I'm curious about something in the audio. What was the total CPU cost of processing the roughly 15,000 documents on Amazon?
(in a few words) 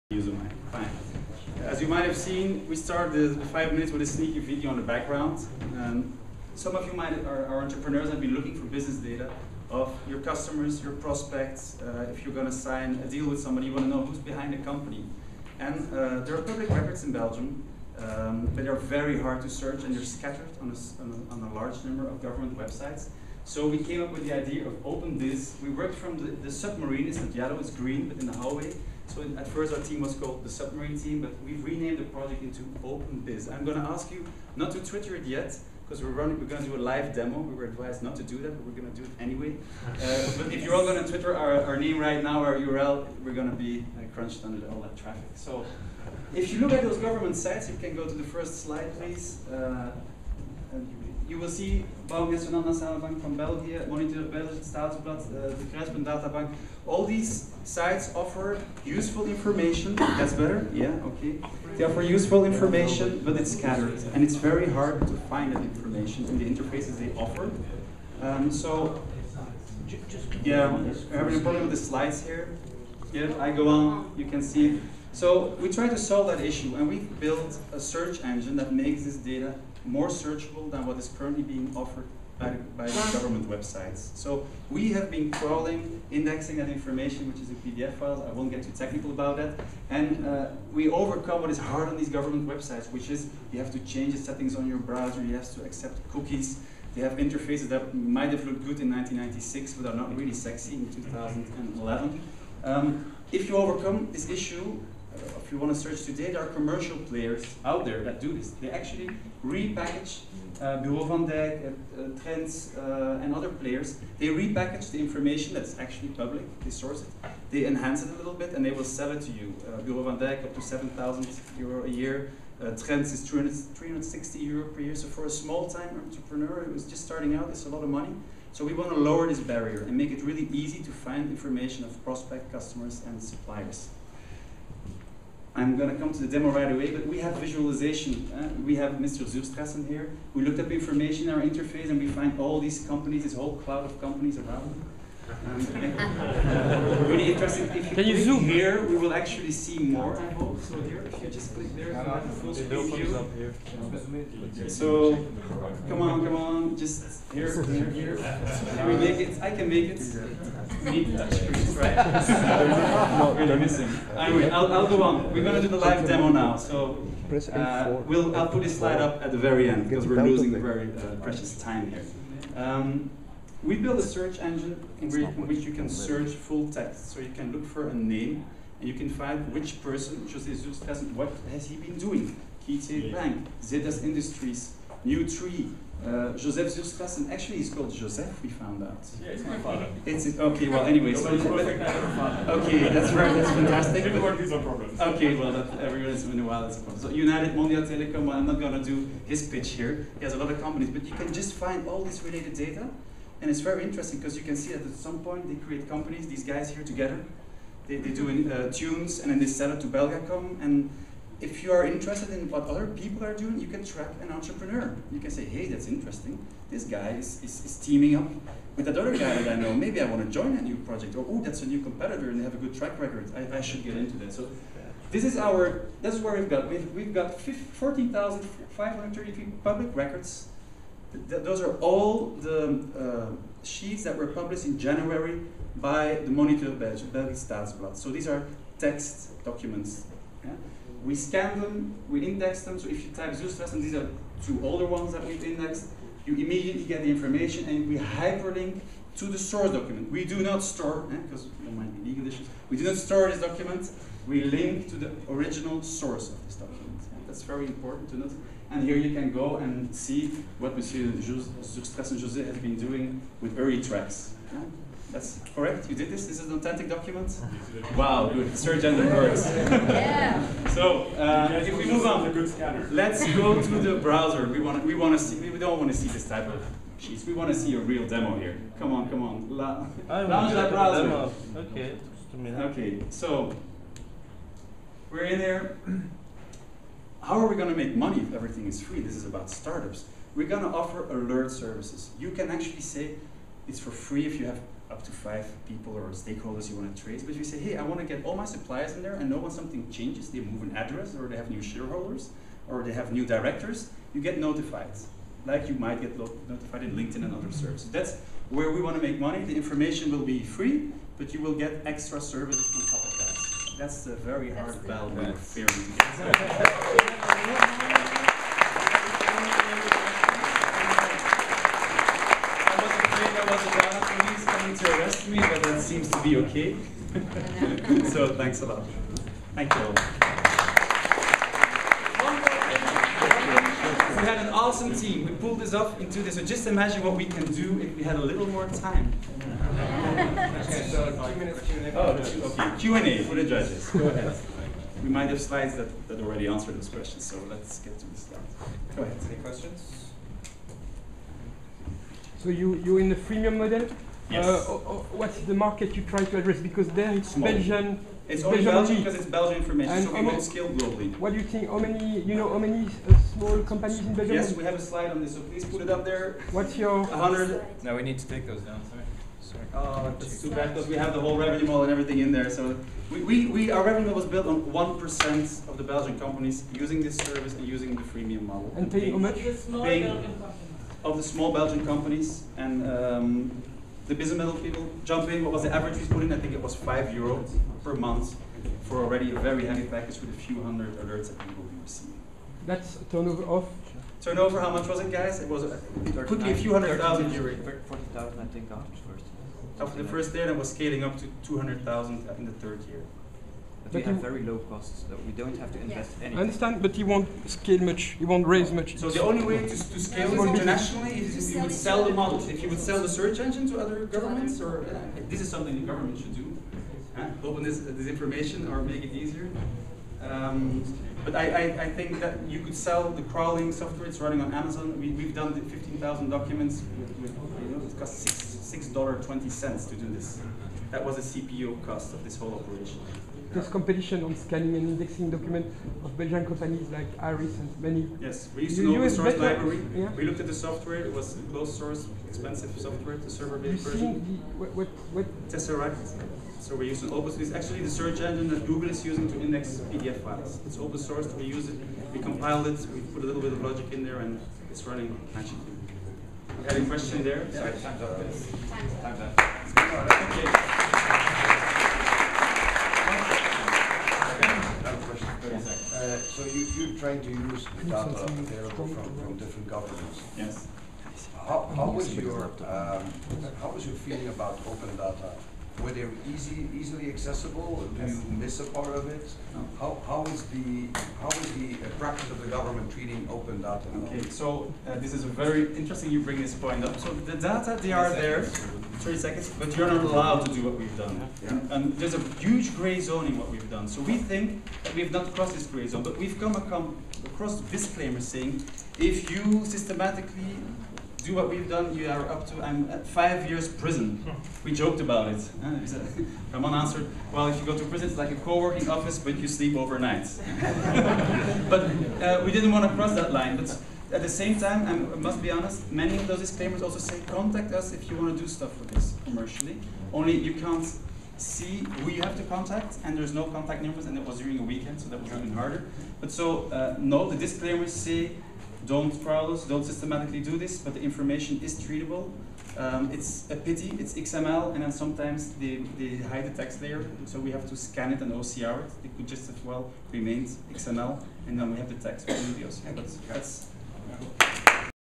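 $6.20.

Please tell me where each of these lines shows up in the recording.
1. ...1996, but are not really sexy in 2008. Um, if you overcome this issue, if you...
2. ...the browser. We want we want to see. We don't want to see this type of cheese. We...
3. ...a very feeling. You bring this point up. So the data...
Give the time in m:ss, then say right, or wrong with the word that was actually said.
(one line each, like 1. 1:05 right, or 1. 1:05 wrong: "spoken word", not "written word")
1. 1:38 wrong: "2011", not "2008"
2. 4:33 right
3. 8:05 wrong: "interesting", not "feeling".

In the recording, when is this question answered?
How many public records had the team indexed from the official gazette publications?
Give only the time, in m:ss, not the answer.
3:47.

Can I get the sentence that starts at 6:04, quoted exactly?
Yes, we have a slide on this, so please put it up there.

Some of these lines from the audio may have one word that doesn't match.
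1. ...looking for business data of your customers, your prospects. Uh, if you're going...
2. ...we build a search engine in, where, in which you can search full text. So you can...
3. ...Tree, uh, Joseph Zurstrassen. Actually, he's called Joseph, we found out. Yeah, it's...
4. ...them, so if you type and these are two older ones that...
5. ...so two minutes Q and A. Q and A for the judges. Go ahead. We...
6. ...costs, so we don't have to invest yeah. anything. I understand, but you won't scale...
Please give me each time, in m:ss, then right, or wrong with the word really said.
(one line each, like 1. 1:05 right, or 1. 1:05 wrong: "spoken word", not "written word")
1. 0:08 right
2. 2:53 right
3. 3:05 right
4. 4:02 right
5. 5:40 right
6. 6:44 right.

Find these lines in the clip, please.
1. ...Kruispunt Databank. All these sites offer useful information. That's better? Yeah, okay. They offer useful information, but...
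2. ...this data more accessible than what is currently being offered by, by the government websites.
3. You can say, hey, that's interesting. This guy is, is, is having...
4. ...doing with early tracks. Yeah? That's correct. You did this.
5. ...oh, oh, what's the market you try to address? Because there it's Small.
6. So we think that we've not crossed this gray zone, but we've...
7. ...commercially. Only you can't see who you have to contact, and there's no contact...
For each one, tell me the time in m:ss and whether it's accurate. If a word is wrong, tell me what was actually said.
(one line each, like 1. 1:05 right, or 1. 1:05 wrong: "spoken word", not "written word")
1. 0:55 right
2. 1:19 wrong: "searchable", not "accessible"
3. 3:35 wrong: "teaming", not "having"
4. 4:22 right
5. 5:54 right
6. 8:13 right
7. 8:39 right.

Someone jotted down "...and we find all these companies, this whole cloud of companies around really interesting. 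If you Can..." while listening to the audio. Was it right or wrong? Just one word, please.
right.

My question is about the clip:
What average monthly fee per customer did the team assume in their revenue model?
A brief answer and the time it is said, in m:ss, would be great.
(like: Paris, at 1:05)
5 euro, at 6:26.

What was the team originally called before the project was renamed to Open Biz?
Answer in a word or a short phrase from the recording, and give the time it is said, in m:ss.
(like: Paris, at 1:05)
the submarine team, at 0:30.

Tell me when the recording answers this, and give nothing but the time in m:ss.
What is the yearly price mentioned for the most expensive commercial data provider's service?
2:00.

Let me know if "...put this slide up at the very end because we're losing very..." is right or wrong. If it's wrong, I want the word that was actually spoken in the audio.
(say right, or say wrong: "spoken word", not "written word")
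right.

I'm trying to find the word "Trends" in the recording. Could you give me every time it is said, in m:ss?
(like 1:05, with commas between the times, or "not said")
1:52, 2:02.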